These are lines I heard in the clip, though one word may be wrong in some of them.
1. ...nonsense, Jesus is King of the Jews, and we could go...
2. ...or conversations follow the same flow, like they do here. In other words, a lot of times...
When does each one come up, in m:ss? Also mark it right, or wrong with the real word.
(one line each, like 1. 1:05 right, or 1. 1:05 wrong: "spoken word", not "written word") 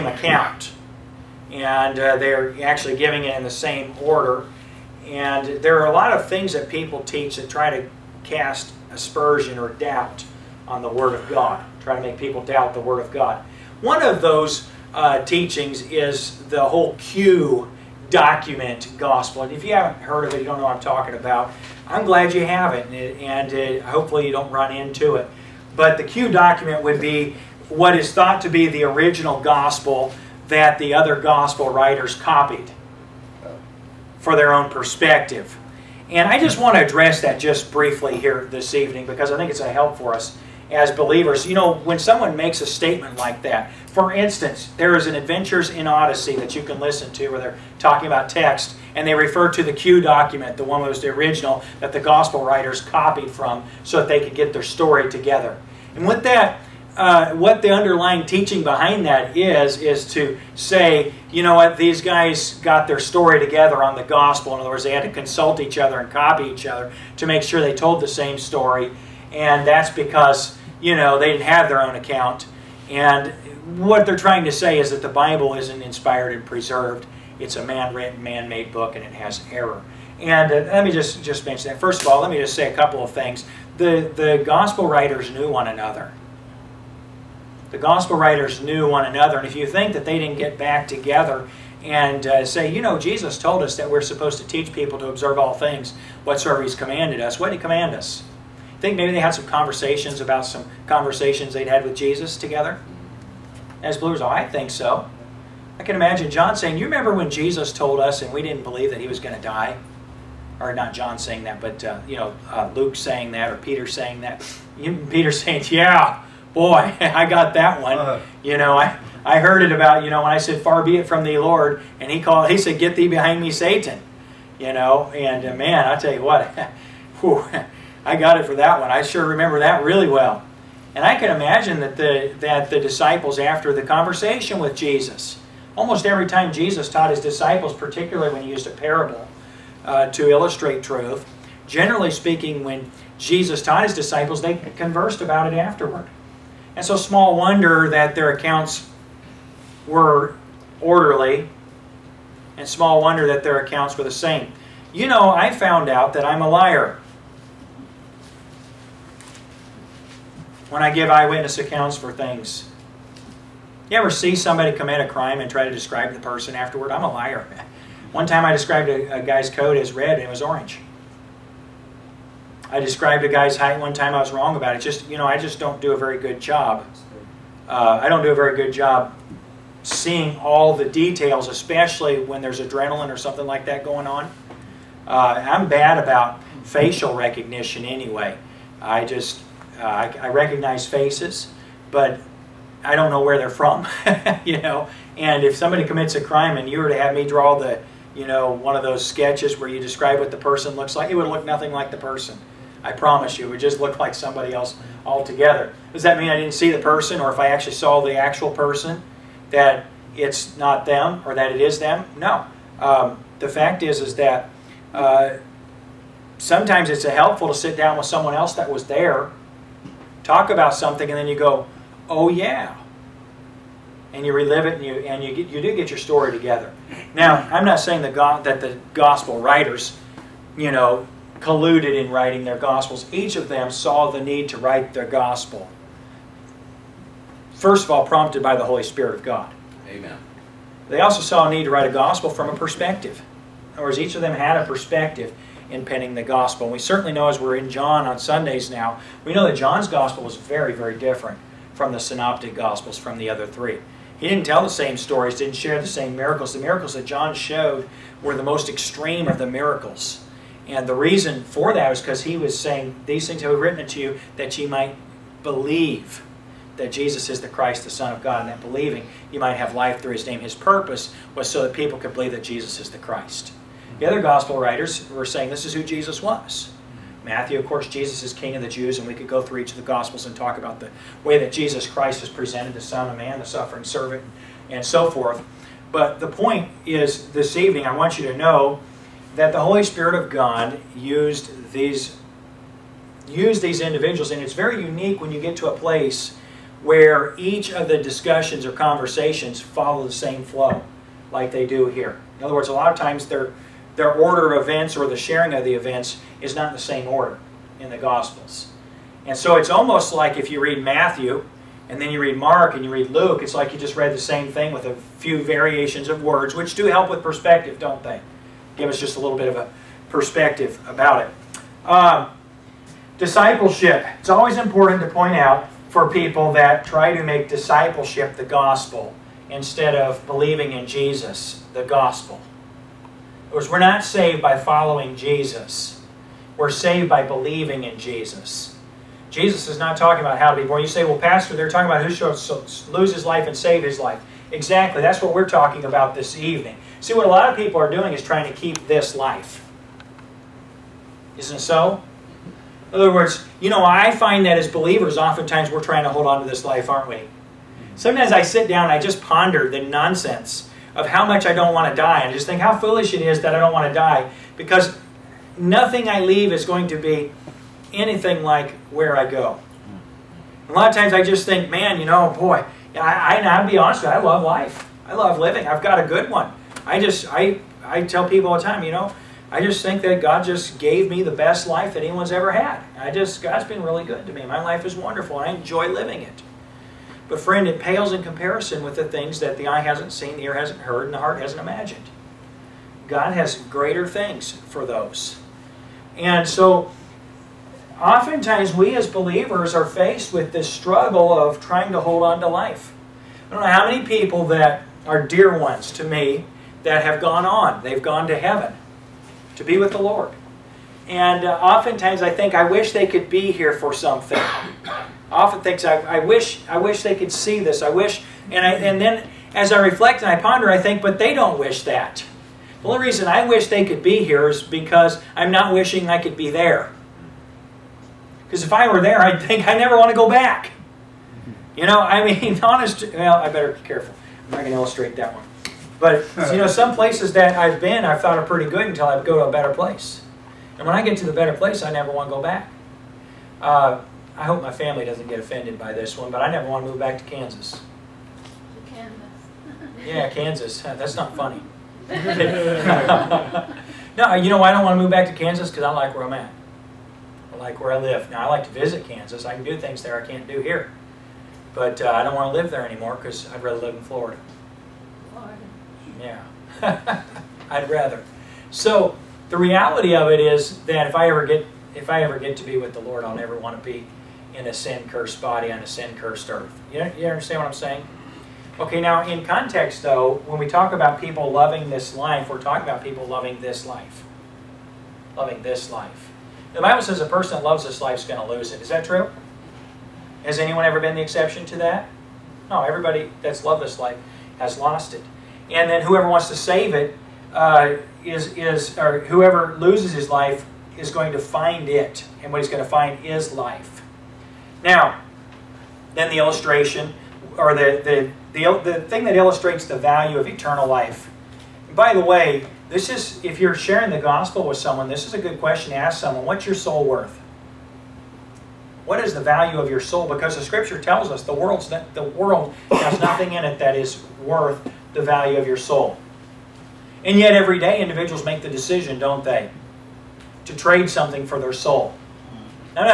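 1. 4:37 wrong: "course", not "nonsense"
2. 4:58 right.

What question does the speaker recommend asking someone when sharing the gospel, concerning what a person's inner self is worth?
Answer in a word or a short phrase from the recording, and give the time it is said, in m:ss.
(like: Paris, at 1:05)
What's your soul worth?, at 8:36.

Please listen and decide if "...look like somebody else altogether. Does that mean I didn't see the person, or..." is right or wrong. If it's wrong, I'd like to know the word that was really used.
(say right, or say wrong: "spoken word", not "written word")
right.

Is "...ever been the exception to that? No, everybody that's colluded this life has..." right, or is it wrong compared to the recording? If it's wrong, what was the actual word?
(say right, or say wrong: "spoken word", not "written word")
wrong: "loved", not "colluded".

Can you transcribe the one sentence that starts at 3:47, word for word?
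Now, I'm not saying the that the gospel writers, you know, colluded in writing their Gospels.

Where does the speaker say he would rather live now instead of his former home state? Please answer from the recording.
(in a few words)
Florida.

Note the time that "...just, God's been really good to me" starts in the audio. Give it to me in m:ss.
6:23.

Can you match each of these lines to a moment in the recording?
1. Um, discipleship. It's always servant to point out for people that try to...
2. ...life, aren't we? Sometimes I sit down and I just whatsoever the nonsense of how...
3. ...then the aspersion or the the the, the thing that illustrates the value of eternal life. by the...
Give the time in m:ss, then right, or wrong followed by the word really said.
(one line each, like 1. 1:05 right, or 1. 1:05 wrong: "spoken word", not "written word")
1. 5:21 wrong: "important", not "servant"
2. 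5:56 wrong: "ponder", not "whatsoever"
3. 8:26 wrong: "illustration", not "aspersion".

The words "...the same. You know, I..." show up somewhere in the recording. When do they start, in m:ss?
2:34.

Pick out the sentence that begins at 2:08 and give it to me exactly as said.
I sure remember that really well.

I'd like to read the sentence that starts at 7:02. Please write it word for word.
The only reason I wish they could be here is because I'm not wishing I could be there.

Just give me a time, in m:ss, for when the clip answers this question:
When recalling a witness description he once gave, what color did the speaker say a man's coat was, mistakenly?
2:49.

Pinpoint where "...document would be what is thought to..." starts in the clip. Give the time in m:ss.
0:26.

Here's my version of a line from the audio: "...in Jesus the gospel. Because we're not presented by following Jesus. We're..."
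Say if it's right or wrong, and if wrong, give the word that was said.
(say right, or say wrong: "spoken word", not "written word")
wrong: "saved", not "presented".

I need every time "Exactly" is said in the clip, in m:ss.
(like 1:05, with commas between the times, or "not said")
5:44.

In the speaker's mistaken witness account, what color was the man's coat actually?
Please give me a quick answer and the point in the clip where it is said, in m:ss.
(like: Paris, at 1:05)
orange, at 2:50.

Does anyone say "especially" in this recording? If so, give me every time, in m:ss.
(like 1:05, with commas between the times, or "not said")
3:01.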